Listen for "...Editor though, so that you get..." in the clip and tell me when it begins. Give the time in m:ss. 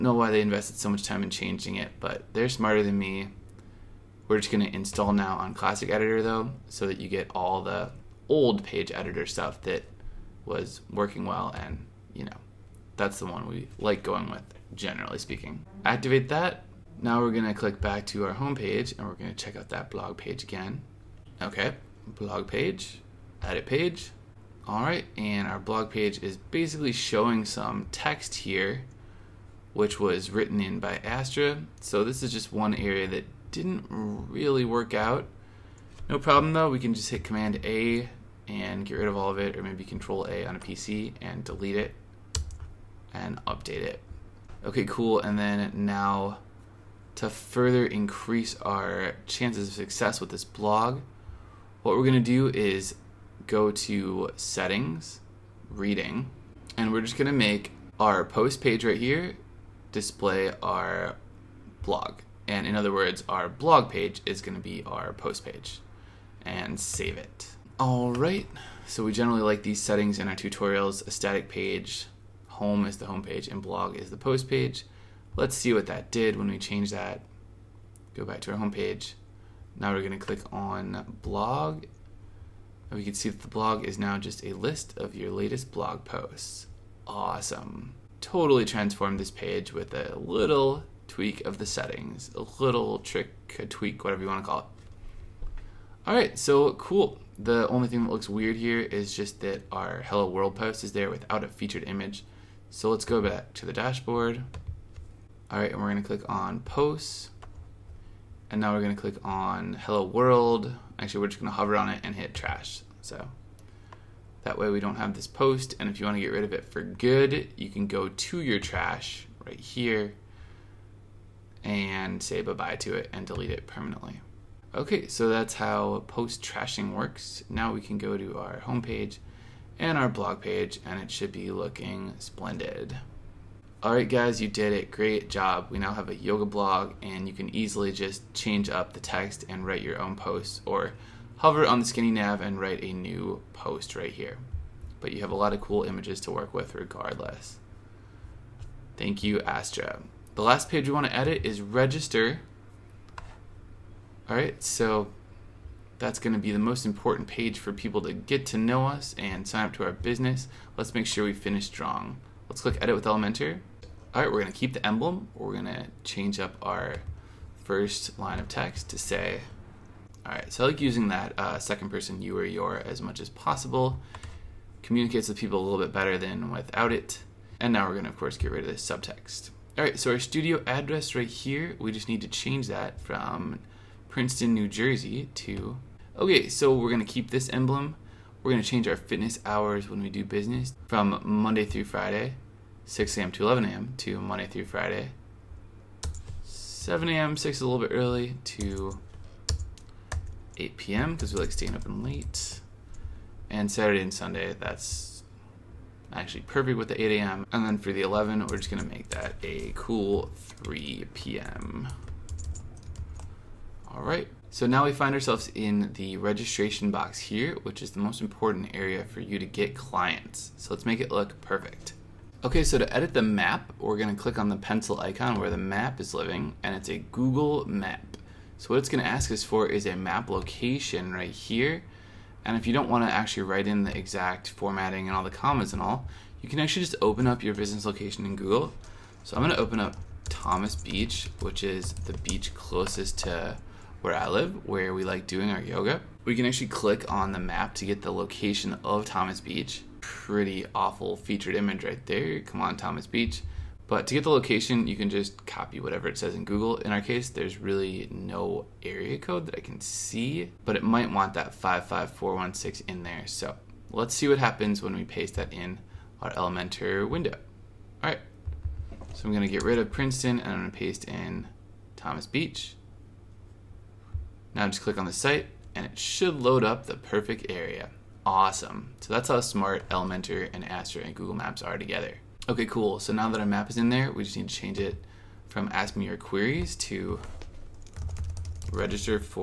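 0:05.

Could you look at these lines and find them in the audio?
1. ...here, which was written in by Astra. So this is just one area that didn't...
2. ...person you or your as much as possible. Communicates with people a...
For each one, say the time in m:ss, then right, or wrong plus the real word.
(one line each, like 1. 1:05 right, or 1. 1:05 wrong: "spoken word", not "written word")
1. 0:28 right
2. 2:51 right.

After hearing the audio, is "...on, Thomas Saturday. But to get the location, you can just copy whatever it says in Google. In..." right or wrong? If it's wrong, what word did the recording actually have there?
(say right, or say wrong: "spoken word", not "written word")
wrong: "Beach", not "Saturday".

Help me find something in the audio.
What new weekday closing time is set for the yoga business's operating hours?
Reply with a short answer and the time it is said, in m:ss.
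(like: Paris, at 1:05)
8 p.m., at 3:20.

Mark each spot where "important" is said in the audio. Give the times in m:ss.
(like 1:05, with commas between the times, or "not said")
2:36, 3:38.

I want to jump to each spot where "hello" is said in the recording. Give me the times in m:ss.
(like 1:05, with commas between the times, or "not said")
1:40, 1:49.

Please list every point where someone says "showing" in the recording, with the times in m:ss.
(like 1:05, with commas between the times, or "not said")
0:26.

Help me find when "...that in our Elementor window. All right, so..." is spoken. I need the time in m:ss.
4:25.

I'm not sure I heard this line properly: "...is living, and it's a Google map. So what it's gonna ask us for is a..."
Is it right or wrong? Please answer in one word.
right.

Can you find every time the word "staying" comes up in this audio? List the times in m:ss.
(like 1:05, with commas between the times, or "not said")
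3:21.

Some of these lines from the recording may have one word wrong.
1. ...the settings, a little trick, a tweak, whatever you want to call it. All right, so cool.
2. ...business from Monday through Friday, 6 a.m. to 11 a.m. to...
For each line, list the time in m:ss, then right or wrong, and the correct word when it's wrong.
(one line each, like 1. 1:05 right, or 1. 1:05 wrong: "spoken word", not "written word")
1. 1:31 right
2. 3:10 right.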